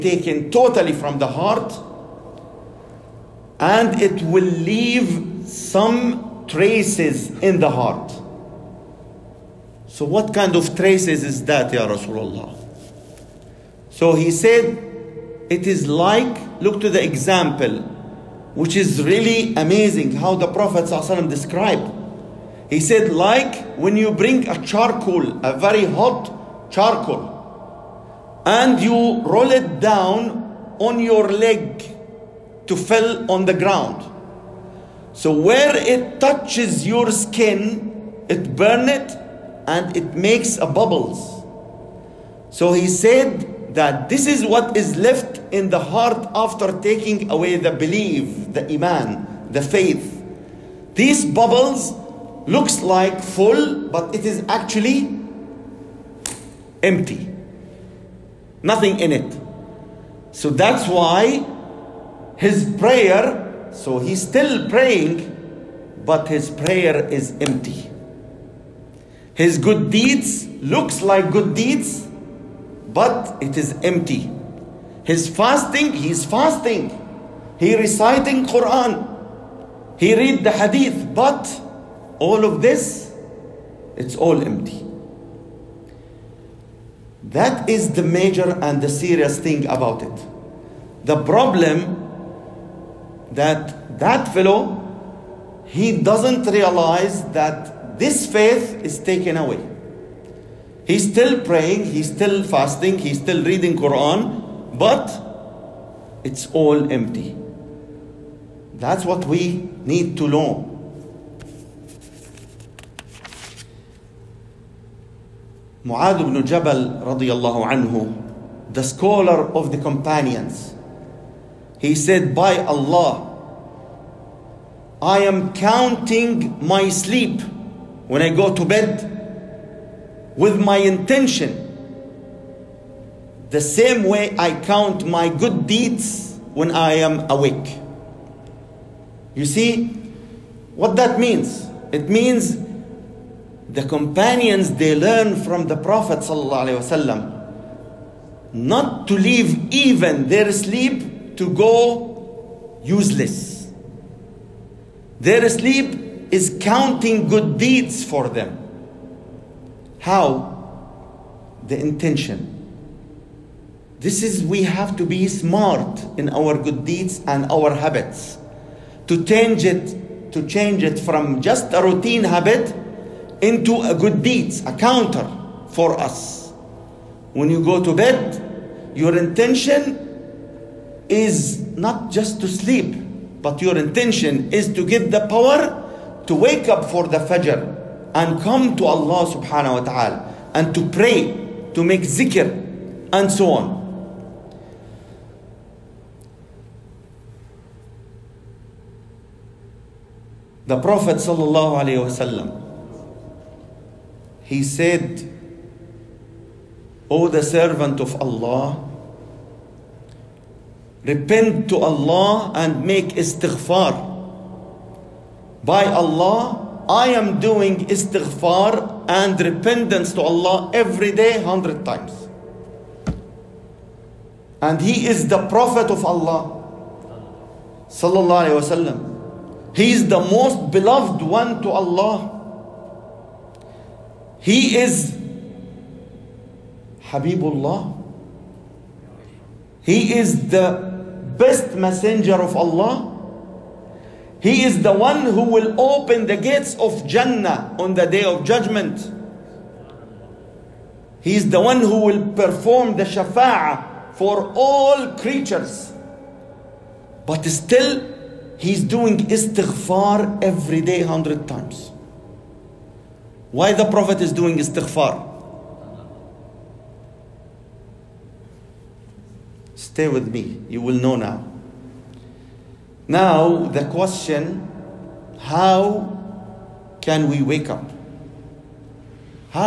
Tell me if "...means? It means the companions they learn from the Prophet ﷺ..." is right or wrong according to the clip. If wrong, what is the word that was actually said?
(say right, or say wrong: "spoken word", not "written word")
right.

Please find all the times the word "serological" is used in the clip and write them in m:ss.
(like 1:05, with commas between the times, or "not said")
not said.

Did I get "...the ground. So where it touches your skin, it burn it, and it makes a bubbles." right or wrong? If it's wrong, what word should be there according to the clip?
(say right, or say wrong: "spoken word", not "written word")
right.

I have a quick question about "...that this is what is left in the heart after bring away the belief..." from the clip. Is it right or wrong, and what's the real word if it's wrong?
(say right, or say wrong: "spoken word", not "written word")
wrong: "taking", not "bring".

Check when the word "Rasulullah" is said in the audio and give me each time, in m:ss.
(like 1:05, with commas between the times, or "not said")
0:11.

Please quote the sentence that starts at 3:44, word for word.
And he is the Prophet of Allah.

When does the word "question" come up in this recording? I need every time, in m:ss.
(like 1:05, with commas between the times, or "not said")
4:33.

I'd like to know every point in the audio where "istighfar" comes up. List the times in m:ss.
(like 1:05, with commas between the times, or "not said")
3:33, 3:37, 4:19, 4:24.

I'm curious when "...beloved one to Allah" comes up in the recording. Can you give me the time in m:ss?
3:50.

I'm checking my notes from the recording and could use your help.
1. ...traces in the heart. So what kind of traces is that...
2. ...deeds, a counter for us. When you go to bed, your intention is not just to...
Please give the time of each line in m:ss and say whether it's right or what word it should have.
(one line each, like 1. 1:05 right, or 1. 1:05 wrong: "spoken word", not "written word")
1. 0:06 right
2. 2:54 right.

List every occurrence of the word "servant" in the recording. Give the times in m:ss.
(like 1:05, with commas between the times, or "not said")
3:27.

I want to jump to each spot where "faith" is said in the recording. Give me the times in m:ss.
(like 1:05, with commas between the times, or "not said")
0:49, 1:38.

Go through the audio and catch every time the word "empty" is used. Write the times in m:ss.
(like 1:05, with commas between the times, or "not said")
0:56, 1:07, 1:13, 1:24, 1:46.